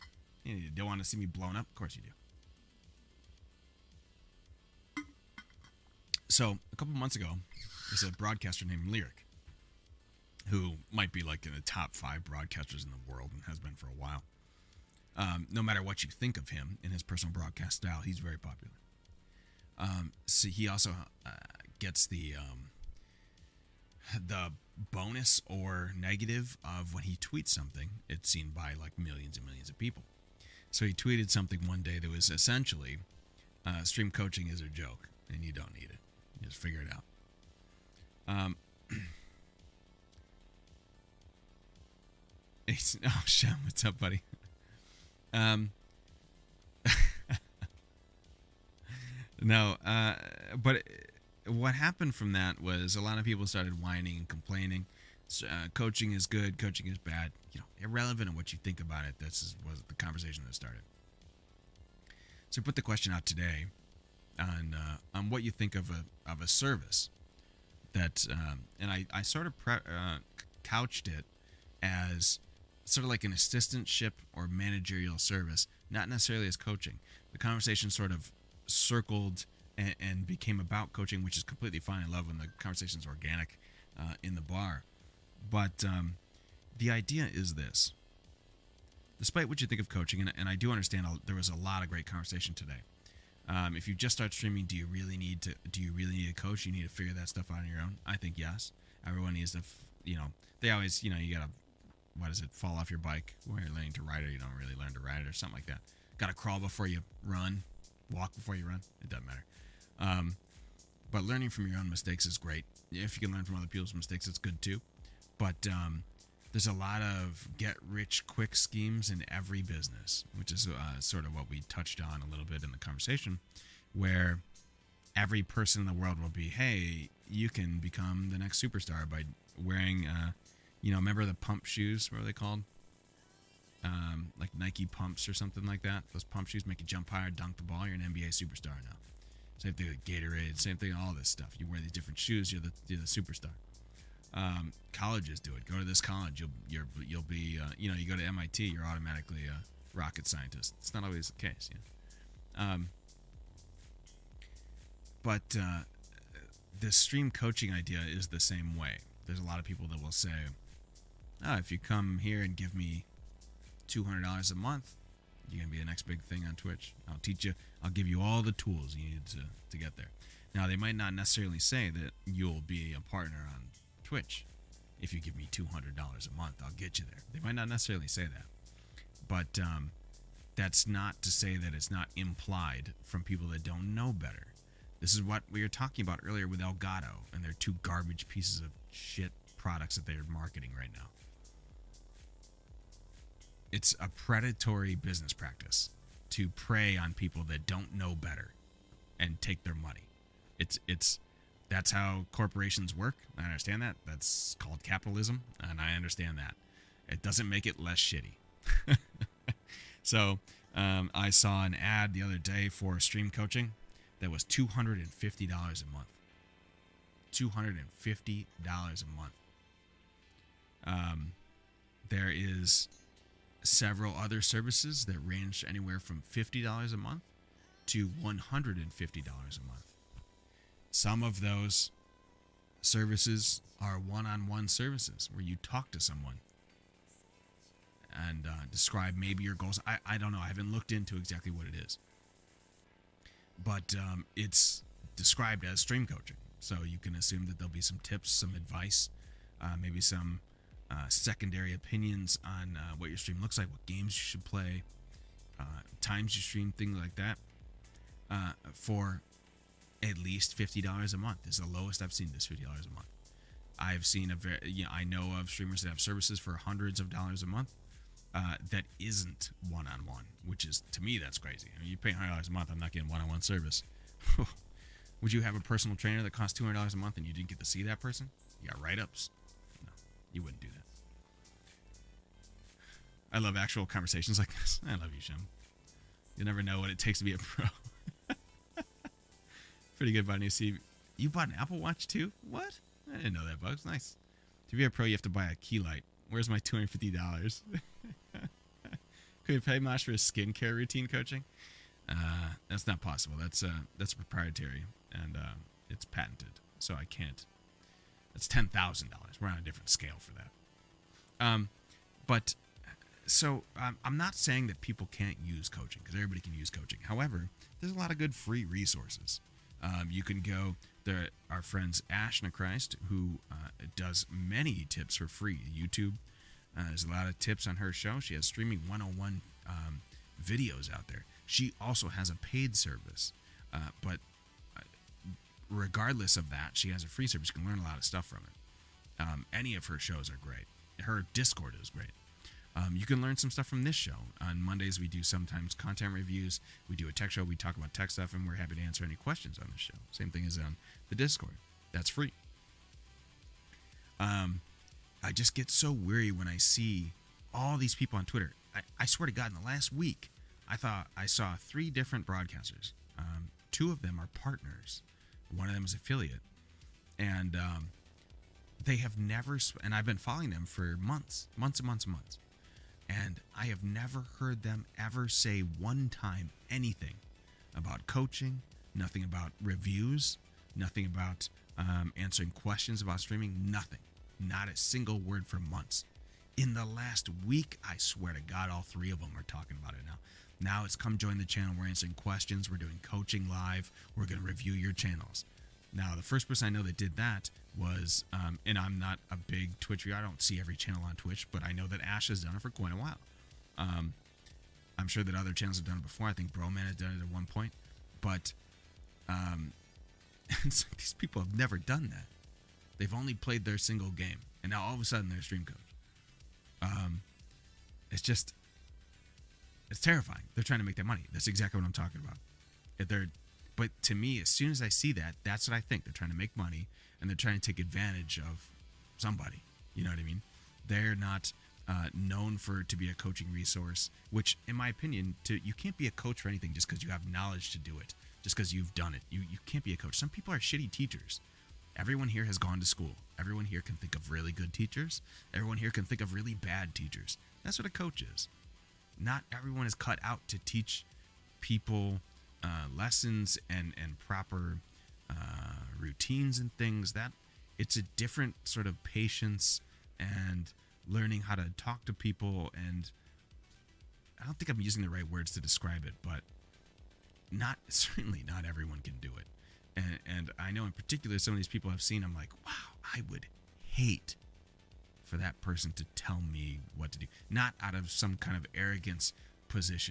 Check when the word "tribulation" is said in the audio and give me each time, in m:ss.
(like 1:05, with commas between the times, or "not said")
not said.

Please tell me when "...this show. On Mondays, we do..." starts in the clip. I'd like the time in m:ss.
5:43.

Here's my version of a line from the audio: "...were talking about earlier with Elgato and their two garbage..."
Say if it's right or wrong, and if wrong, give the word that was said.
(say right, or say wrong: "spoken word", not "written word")
right.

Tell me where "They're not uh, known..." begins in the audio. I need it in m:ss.
7:10.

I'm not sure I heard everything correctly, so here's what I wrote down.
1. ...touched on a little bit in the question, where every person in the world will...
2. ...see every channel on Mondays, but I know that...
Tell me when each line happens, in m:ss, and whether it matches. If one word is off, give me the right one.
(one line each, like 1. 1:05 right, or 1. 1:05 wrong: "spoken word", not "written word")
1. 2:01 wrong: "conversation", not "question"
2. 6:40 wrong: "Twitch", not "Mondays".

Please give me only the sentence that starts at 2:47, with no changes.
I'll give you all the tools you need to, to get there.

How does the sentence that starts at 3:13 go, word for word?
It's a predatory business practice to prey on people that don't know better and take their money.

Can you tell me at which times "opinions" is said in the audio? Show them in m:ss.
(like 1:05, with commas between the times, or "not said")
4:11, 7:14.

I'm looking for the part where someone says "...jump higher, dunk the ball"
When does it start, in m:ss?
2:16.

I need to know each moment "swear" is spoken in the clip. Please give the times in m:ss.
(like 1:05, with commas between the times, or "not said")
5:59, 6:27.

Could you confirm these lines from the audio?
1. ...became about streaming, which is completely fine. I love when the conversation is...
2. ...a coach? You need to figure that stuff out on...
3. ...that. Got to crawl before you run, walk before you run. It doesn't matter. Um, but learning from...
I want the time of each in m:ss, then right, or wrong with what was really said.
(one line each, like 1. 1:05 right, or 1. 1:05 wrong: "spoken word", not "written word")
1. 1:20 wrong: "coaching", not "streaming"
2. 1:36 right
3. 1:45 right.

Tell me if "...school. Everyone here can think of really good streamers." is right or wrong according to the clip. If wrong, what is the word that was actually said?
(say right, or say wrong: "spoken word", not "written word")
wrong: "teachers", not "streamers".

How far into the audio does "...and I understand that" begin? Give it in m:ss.
3:25.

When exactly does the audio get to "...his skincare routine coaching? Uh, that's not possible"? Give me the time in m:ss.
5:00.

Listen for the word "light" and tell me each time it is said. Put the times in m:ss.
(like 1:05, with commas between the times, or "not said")
4:55.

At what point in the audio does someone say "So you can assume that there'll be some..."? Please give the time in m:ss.
4:06.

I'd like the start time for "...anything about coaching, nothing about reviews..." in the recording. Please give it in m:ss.
6:16.